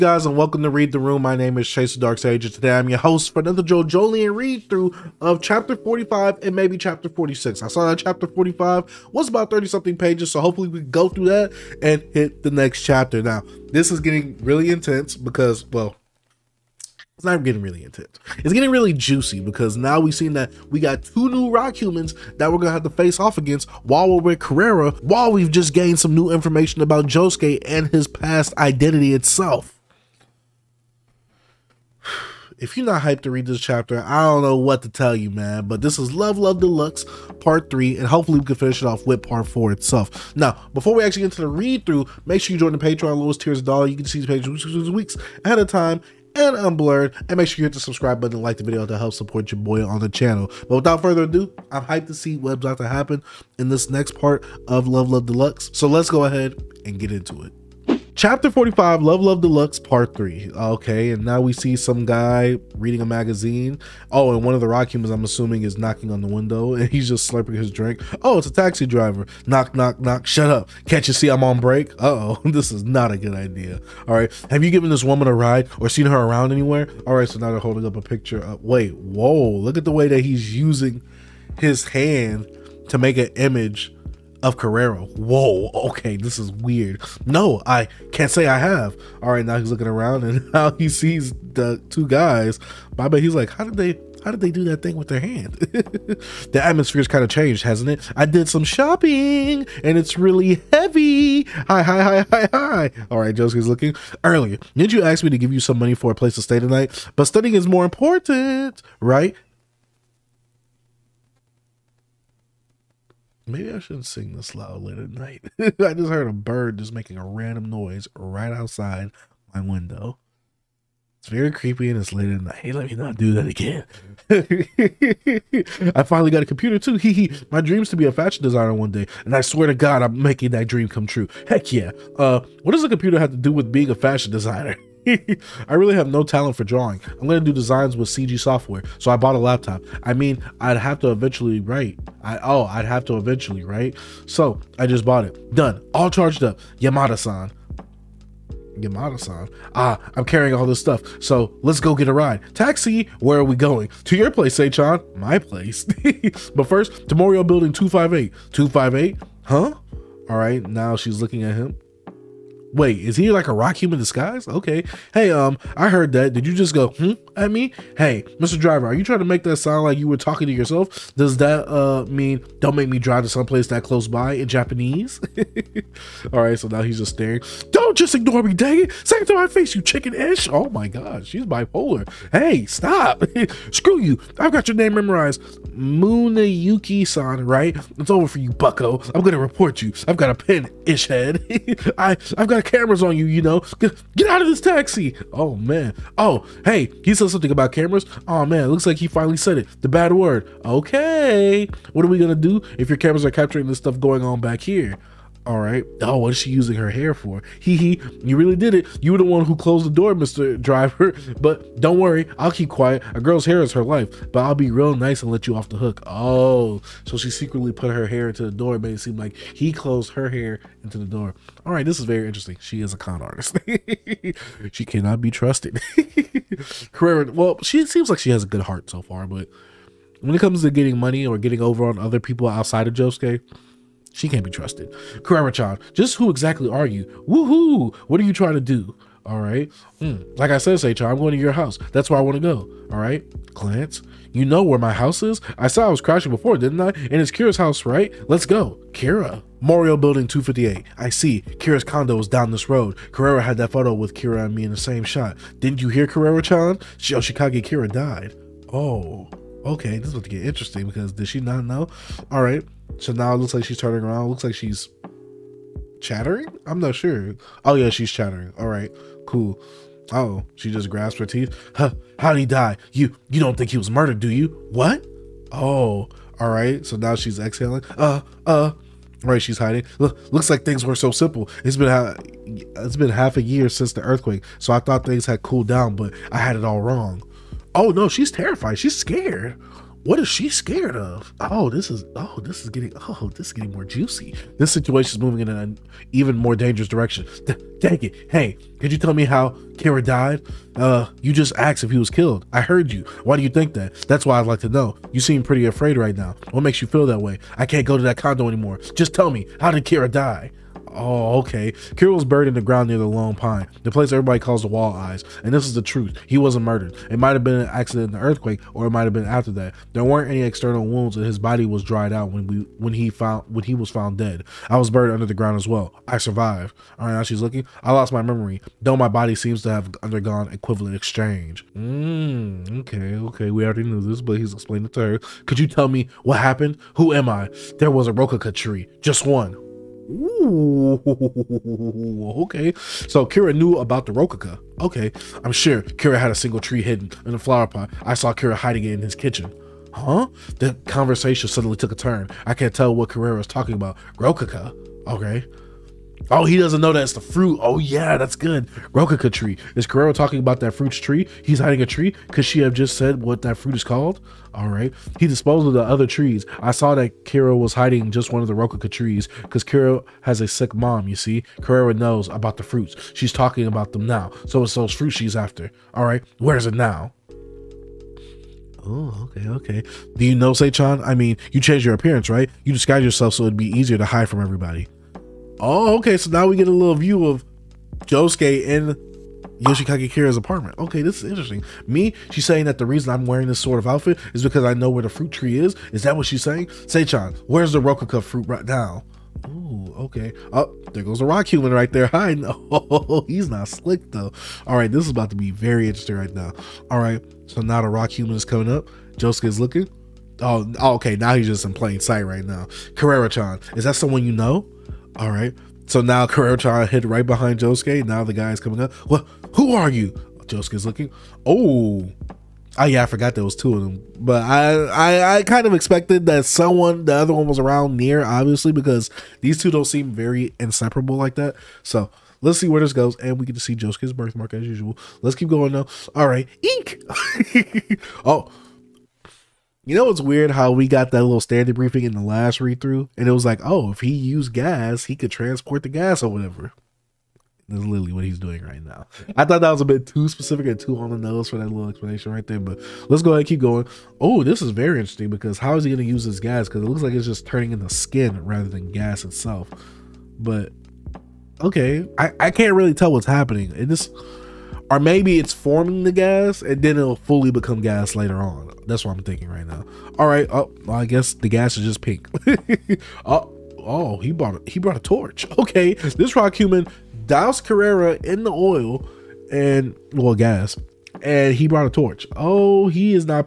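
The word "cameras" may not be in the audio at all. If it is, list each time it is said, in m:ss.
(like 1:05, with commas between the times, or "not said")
3:12, 3:17, 3:22.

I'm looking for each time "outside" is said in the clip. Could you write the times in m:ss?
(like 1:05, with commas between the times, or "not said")
1:58, 3:52.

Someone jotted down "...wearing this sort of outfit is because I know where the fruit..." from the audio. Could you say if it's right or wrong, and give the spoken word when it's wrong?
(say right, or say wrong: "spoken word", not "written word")
right.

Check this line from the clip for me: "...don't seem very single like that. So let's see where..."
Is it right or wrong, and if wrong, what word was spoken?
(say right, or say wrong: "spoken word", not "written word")
wrong: "inseparable", not "single".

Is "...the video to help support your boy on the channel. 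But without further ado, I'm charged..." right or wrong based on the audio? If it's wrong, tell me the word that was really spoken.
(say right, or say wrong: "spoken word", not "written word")
wrong: "hyped", not "charged".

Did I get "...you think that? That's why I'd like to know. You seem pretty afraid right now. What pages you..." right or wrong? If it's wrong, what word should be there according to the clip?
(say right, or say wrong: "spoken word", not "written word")
wrong: "makes", not "pages".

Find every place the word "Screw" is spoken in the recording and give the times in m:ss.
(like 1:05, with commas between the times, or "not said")
3:03.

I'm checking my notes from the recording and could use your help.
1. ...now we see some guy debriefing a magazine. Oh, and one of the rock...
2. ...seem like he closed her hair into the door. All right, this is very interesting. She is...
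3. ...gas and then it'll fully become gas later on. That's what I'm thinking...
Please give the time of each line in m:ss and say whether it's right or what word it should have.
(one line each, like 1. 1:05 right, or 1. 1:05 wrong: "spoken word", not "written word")
1. 1:01 wrong: "reading", not "debriefing"
2. 3:38 right
3. 7:46 right.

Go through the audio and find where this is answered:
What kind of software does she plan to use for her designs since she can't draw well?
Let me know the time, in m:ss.
2:18.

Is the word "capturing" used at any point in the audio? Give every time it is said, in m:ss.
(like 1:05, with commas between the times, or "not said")
3:23.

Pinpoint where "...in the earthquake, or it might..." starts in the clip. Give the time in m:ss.
5:18.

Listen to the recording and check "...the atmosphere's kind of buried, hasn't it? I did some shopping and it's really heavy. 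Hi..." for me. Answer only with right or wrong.
wrong.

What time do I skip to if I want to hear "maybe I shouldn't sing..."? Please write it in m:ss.
1:53.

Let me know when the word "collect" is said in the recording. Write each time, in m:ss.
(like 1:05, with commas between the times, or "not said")
not said.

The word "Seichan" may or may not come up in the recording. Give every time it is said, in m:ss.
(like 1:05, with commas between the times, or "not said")
2:34, 4:00, 6:20, 6:36.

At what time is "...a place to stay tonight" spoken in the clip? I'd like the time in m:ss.
1:46.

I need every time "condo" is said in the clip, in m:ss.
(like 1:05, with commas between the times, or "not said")
4:11, 5:08.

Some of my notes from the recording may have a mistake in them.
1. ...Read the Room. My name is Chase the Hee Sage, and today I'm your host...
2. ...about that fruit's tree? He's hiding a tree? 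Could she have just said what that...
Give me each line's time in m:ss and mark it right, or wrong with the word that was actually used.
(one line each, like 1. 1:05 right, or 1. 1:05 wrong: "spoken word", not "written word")
1. 0:00 wrong: "Dark", not "Hee"
2. 6:00 right.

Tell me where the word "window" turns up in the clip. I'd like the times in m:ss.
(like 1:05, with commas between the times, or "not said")
1:06, 1:59.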